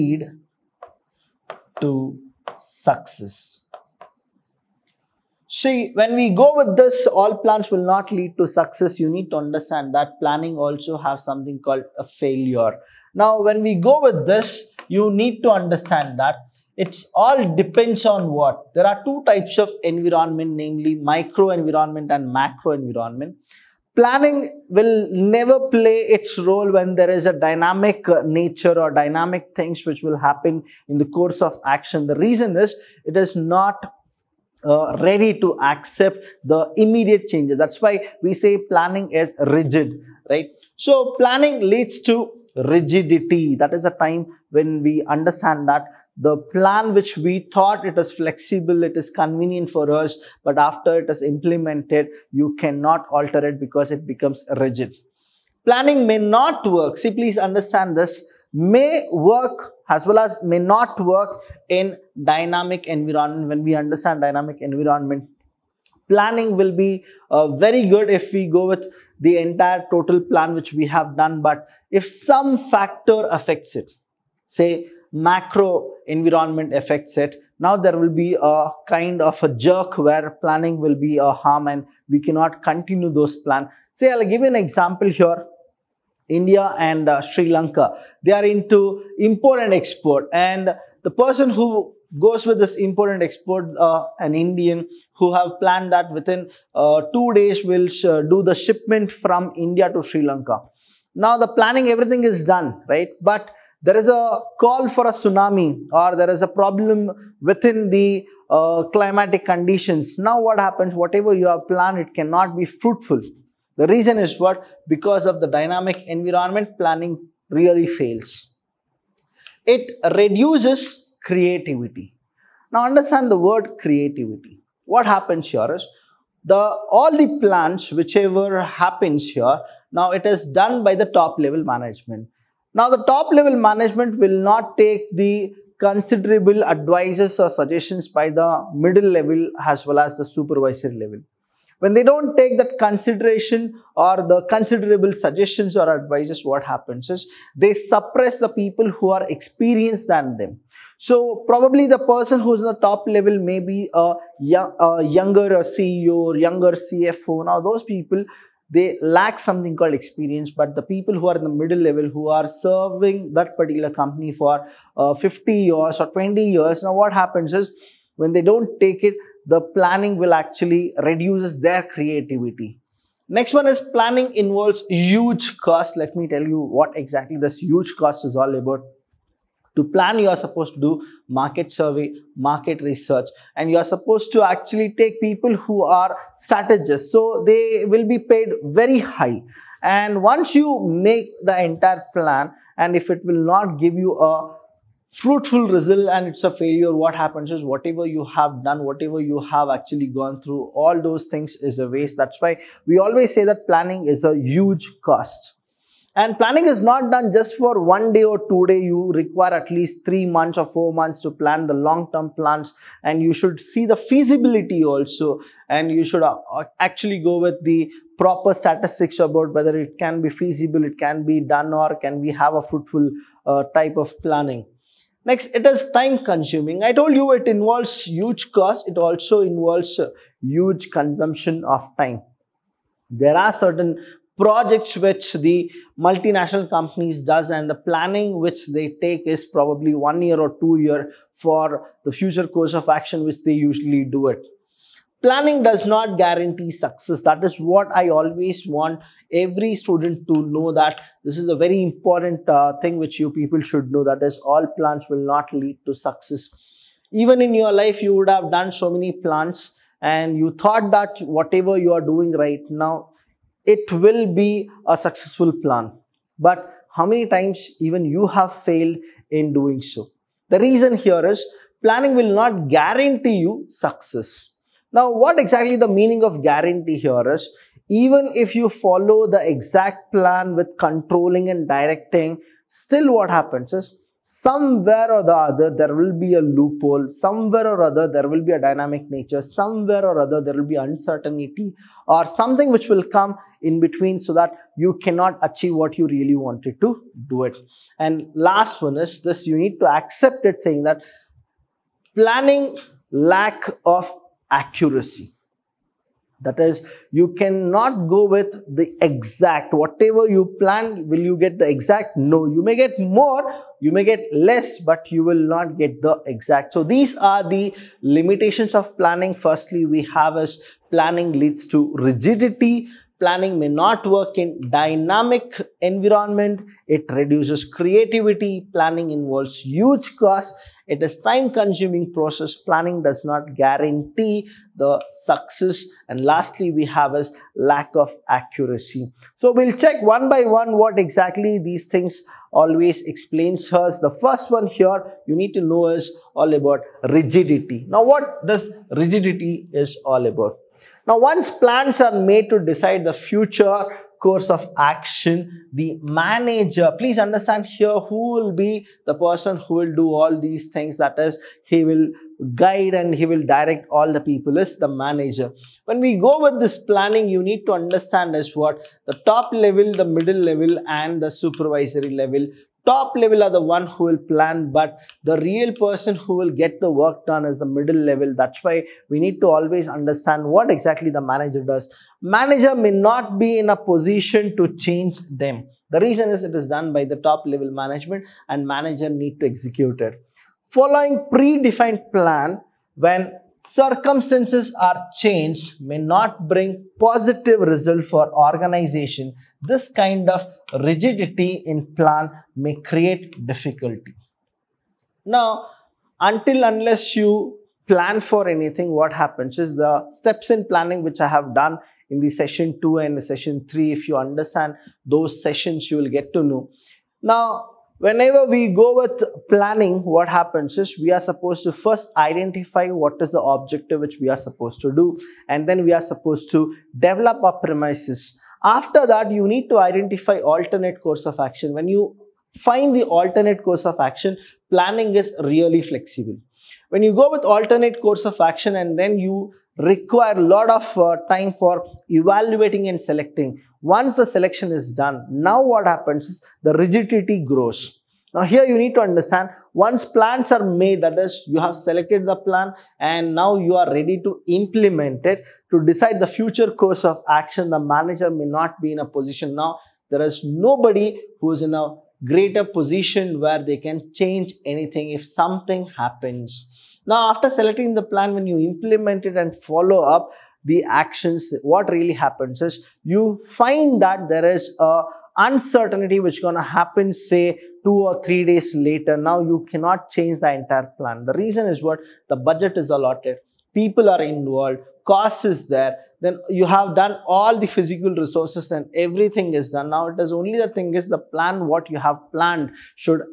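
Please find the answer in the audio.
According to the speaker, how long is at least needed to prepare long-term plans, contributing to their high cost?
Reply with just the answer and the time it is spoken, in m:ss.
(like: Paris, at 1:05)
3 or 4 months, at 3:30.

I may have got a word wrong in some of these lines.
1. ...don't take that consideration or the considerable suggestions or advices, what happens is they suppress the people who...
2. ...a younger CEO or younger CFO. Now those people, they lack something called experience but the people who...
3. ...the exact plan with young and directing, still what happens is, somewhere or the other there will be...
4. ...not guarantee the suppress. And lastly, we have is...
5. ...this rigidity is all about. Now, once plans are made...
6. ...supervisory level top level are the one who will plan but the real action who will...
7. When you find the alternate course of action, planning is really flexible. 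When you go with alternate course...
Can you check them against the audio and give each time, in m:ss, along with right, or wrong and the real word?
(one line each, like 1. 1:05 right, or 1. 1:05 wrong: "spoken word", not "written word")
1. 2:22 right
2. 2:34 right
3. 4:39 wrong: "controlling", not "young"
4. 5:33 wrong: "success", not "suppress"
5. 5:48 right
6. 6:11 wrong: "person", not "action"
7. 7:11 right.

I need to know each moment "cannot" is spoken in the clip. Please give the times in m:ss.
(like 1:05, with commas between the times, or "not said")
0:52, 1:22, 1:52, 4:55, 5:07, 7:59.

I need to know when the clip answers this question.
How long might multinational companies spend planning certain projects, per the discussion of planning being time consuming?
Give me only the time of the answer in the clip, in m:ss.
3:59.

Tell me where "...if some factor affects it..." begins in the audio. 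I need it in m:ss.
1:11.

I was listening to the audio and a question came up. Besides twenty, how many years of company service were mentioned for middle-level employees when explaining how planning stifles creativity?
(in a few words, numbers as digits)
50.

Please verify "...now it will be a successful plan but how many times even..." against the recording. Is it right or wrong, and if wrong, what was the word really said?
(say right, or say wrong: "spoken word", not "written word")
right.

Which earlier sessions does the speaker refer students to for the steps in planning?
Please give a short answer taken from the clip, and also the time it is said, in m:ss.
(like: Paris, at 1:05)
Sessions 2 and 3, at 6:52.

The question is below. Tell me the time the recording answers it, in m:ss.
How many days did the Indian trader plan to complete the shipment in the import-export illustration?
1:37.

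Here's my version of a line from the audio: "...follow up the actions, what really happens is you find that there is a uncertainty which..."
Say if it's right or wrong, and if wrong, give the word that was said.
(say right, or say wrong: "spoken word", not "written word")
right.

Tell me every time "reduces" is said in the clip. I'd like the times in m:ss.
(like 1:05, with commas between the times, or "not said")
2:00, 2:51, 5:27.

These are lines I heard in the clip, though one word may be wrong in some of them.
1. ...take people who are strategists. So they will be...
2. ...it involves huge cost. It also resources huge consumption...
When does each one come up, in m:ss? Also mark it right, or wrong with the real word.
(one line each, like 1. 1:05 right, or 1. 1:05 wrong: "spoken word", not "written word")
1. 3:04 right
2. 3:47 wrong: "involves", not "resources".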